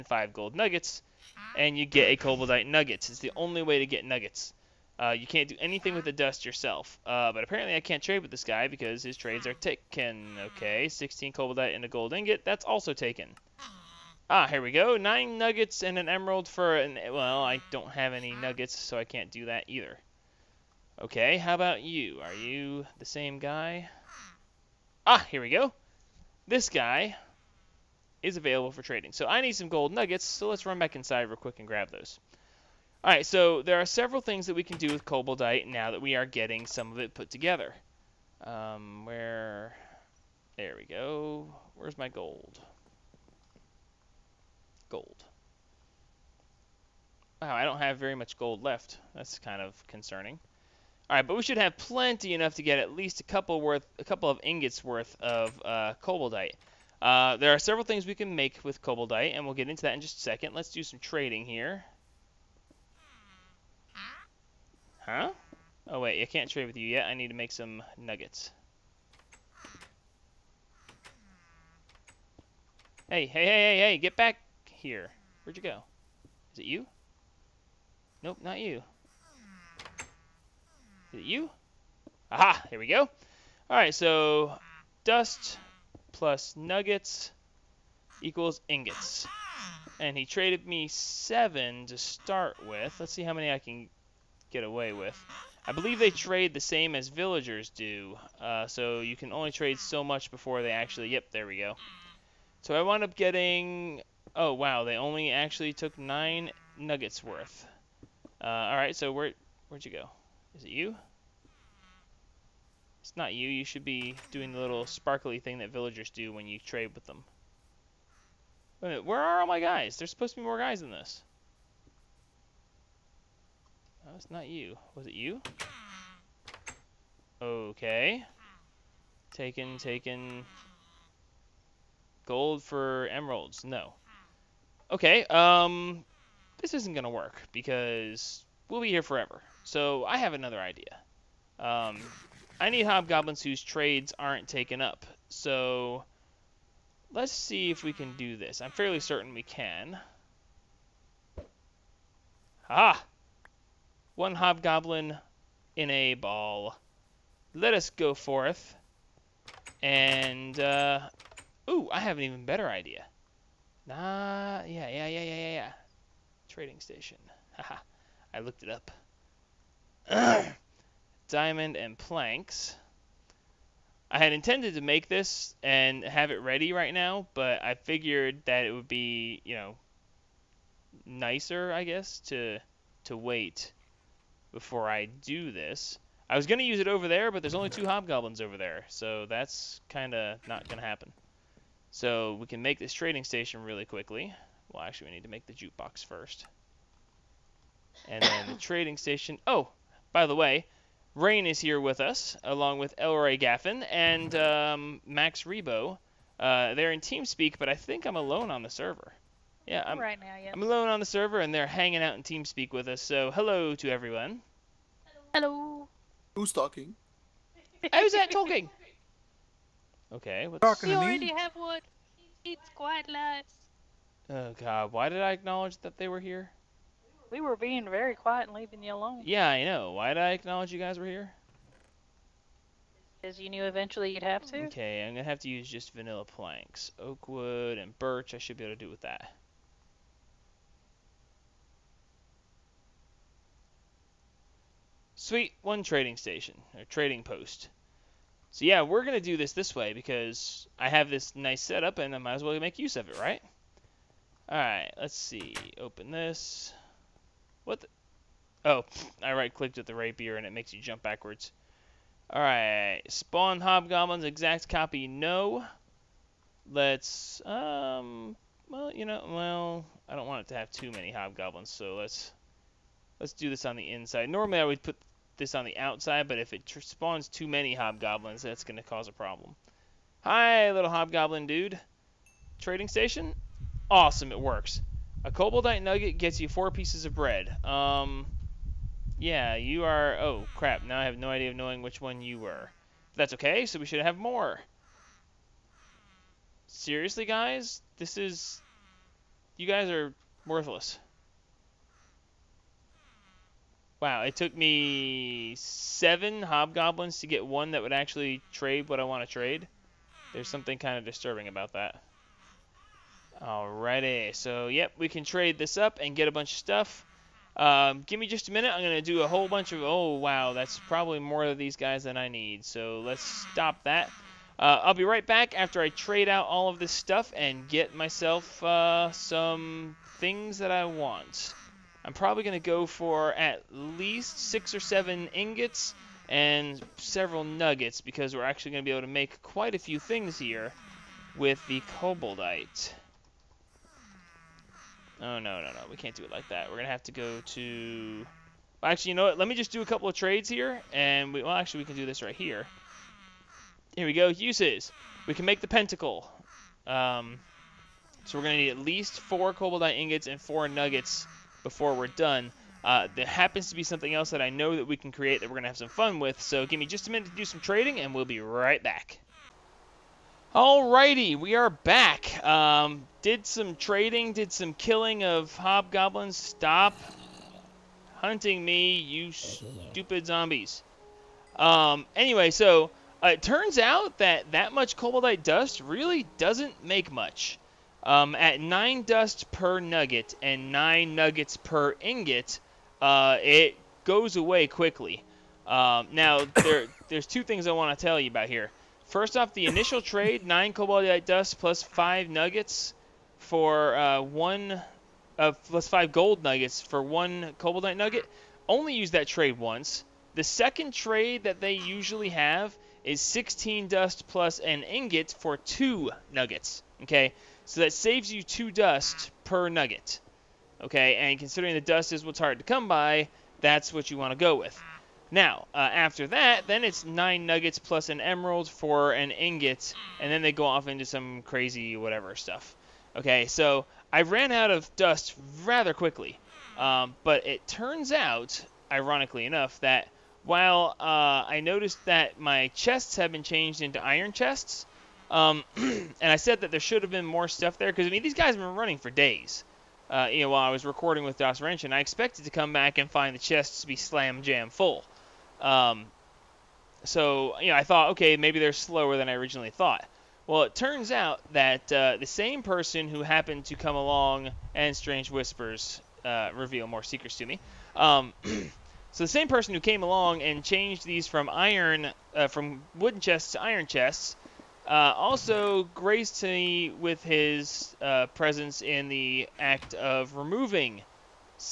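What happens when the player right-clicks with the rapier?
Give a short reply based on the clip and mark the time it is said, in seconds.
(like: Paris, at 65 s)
You jump backwards, at 260 s.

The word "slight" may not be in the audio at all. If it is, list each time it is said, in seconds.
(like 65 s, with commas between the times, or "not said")
not said.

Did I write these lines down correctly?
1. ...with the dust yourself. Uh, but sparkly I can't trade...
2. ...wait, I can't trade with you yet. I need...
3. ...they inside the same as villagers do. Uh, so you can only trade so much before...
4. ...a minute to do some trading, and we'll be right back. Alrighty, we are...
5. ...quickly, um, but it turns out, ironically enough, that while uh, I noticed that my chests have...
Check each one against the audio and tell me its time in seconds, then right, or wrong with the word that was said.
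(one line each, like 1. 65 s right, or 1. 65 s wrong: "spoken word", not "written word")
1. 5 s wrong: "apparently", not "sparkly"
2. 66 s right
3. 95 s wrong: "trade", not "inside"
4. 367 s right
5. 435 s right.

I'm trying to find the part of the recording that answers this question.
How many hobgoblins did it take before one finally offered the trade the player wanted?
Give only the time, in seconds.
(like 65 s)
305 s.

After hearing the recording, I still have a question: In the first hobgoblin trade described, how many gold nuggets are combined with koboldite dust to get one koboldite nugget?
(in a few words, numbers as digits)
5.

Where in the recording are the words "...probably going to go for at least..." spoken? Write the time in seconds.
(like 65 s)
332 s.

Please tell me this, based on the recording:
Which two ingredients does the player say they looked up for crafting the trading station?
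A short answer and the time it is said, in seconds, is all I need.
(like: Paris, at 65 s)
Diamond and planks, at 171 s.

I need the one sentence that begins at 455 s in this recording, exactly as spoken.
Um, so you know, I thought, okay, maybe they're slower than I originally thought.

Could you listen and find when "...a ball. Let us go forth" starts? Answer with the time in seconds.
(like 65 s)
155 s.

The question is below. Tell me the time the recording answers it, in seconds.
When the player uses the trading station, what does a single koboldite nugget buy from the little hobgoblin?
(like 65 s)
286 s.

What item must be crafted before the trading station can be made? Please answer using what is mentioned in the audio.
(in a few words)
Jukebox.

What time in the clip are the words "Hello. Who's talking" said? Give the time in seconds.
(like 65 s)
215 s.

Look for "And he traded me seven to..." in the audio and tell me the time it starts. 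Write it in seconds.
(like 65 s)
89 s.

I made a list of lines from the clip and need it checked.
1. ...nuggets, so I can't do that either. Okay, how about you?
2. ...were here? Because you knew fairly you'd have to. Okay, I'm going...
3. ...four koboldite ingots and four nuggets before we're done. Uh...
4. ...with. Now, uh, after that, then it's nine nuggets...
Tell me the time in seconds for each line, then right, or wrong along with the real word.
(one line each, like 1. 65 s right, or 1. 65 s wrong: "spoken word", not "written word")
1. 18 s right
2. 230 s wrong: "eventually", not "fairly"
3. 359 s right
4. 424 s right.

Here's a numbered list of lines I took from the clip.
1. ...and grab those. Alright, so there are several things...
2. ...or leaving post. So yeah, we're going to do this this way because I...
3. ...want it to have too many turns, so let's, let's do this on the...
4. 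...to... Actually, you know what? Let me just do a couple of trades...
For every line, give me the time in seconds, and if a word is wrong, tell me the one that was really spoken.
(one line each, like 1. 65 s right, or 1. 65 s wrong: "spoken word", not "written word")
1. 31 s right
2. 246 s wrong: "trading", not "leaving"
3. 270 s wrong: "hobgoblins", not "turns"
4. 347 s right.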